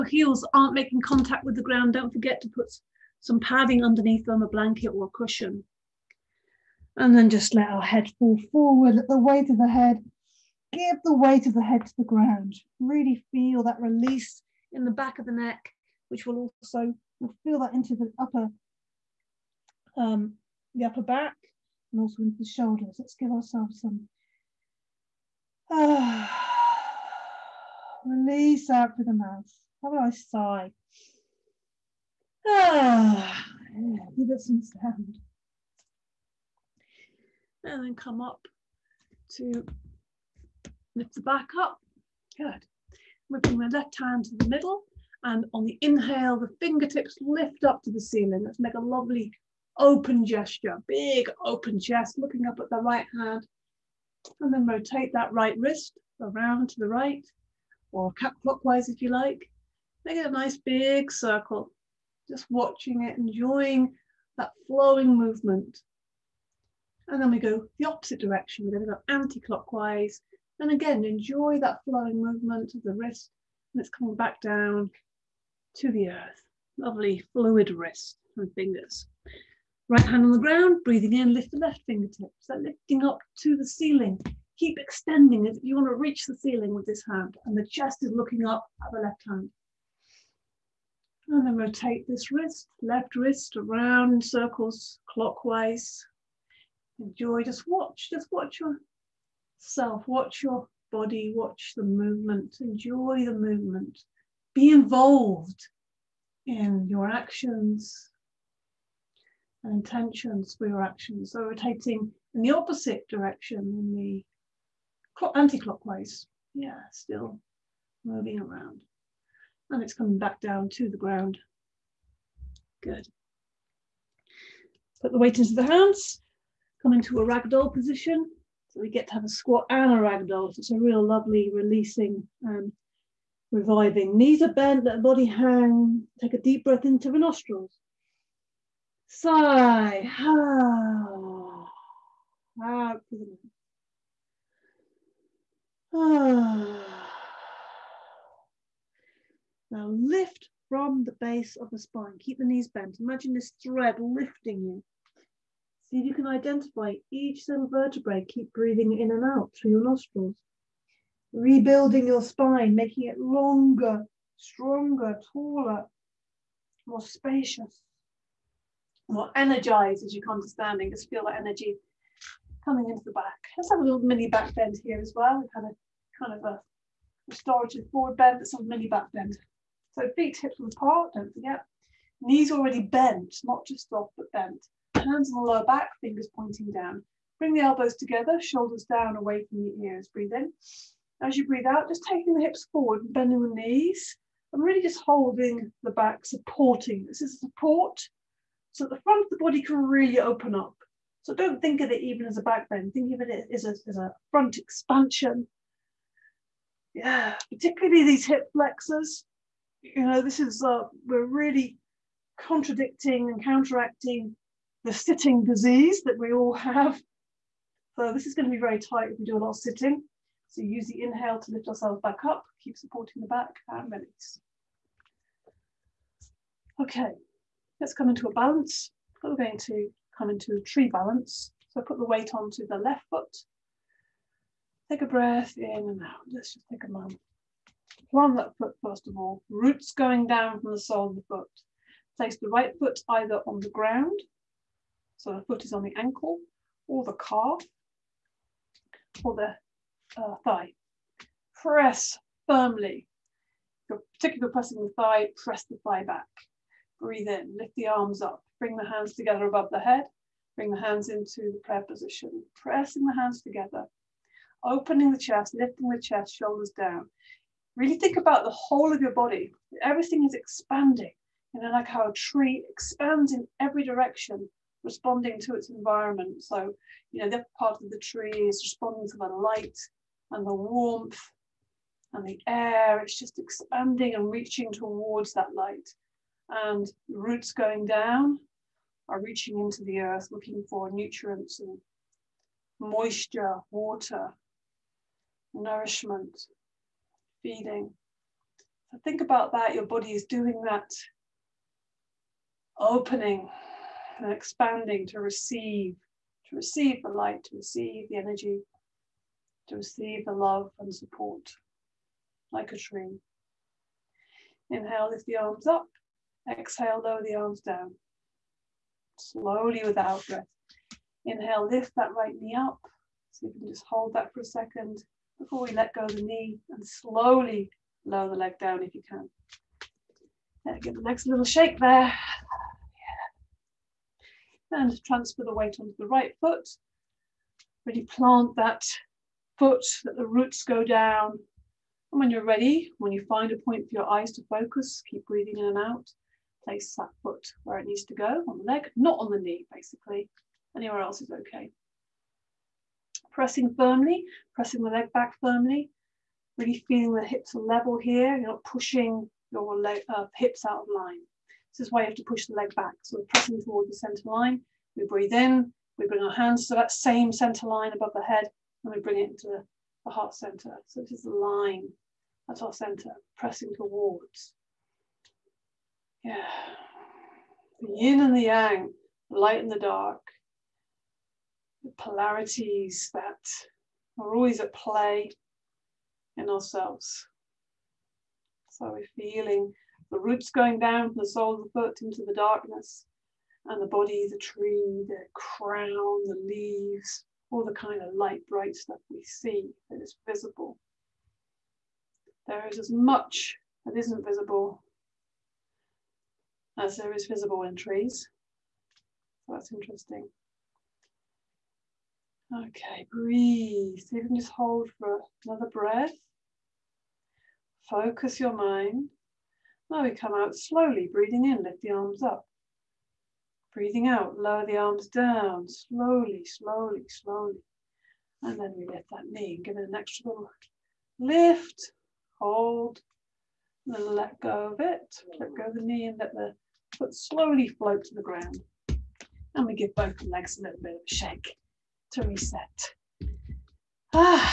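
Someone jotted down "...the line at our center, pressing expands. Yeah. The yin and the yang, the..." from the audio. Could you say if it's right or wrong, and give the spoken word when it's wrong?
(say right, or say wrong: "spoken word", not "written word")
wrong: "towards", not "expands".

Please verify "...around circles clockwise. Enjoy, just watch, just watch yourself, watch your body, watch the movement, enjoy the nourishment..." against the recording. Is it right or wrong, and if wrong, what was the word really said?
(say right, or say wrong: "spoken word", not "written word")
wrong: "movement", not "nourishment".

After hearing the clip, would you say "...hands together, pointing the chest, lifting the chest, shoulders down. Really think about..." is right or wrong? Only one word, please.
wrong.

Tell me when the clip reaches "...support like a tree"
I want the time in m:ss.
5:10.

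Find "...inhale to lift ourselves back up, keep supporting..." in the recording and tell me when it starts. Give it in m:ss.
3:41.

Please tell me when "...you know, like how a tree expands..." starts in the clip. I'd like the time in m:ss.
4:31.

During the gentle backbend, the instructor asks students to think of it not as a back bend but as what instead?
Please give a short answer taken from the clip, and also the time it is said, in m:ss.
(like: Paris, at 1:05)
A front expansion, at 3:24.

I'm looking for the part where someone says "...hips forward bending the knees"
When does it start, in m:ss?
3:12.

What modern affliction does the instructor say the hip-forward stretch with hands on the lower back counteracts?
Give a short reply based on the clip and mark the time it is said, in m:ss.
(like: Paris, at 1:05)
The sitting disease, at 3:34.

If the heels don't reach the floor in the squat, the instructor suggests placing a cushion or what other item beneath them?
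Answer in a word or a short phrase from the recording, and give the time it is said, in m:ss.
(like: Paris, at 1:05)
A blanket, at 0:04.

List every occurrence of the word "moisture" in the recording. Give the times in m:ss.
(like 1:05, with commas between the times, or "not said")
4:52.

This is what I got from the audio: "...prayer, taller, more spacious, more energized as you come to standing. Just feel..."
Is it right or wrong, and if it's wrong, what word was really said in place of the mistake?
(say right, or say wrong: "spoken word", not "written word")
wrong: "stronger", not "prayer".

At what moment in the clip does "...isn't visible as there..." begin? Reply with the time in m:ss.
6:43.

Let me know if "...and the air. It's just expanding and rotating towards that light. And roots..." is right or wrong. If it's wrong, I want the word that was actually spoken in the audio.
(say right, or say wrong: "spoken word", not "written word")
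wrong: "reaching", not "rotating".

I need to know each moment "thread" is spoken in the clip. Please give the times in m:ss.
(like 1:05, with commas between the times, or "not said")
2:33.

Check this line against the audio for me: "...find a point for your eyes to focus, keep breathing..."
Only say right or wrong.
right.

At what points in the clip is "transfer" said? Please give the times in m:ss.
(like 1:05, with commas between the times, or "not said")
5:35.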